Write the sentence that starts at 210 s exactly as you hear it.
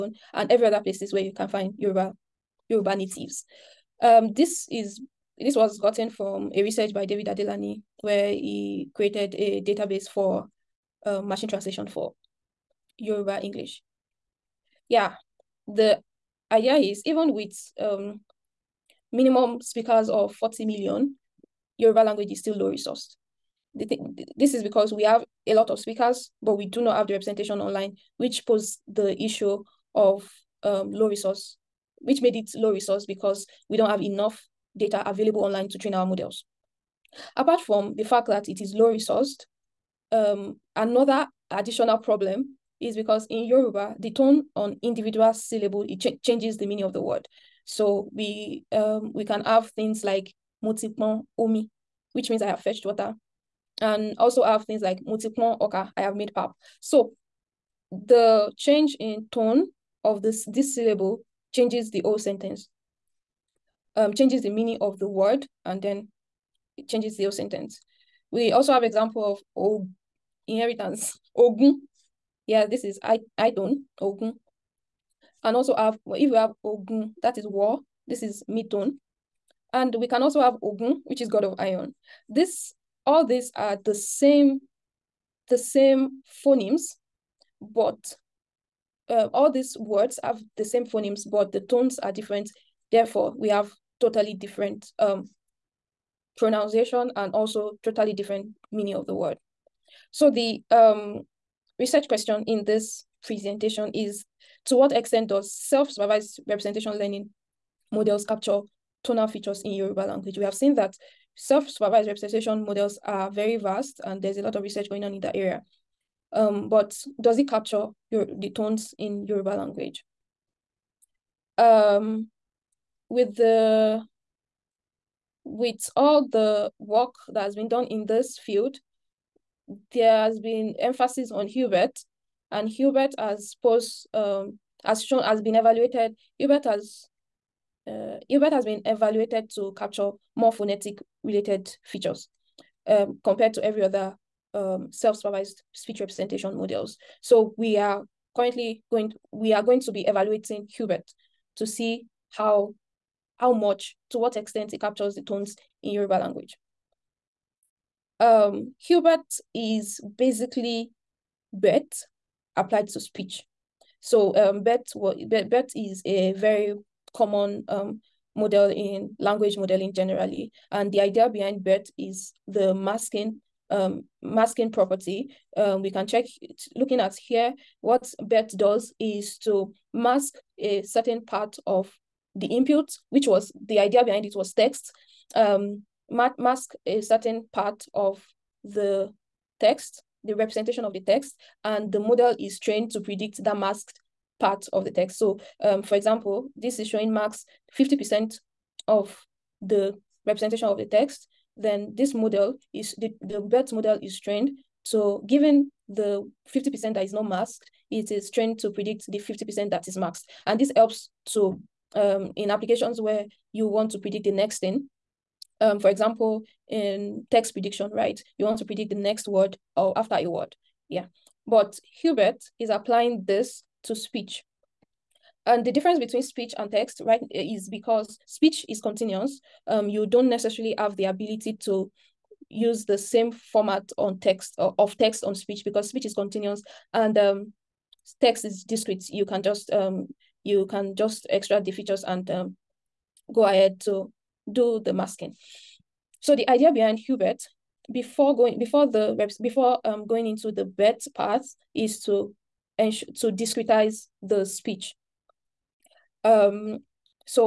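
And this helps to um, in applications where you want to predict the next thing.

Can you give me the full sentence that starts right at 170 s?
And the idea behind BERT is the masking um, masking property.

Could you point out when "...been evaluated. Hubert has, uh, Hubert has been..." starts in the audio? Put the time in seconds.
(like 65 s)
135 s.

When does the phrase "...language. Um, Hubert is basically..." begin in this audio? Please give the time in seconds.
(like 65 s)
156 s.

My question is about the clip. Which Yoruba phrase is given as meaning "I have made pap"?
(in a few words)
motipon oka.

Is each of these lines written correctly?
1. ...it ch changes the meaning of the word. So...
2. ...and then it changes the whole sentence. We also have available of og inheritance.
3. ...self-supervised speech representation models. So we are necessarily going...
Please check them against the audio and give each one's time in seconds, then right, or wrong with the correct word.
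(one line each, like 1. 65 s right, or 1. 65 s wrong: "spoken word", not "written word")
1. 45 s right
2. 65 s wrong: "example", not "available"
3. 144 s wrong: "currently", not "necessarily".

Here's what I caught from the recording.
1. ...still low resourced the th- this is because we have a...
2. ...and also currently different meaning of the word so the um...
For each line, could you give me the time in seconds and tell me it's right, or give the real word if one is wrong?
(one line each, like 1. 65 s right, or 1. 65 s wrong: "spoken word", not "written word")
1. 22 s right
2. 97 s wrong: "totally", not "currently".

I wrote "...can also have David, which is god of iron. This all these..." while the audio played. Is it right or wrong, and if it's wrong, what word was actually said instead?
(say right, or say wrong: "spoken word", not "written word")
wrong: "Ogun", not "David".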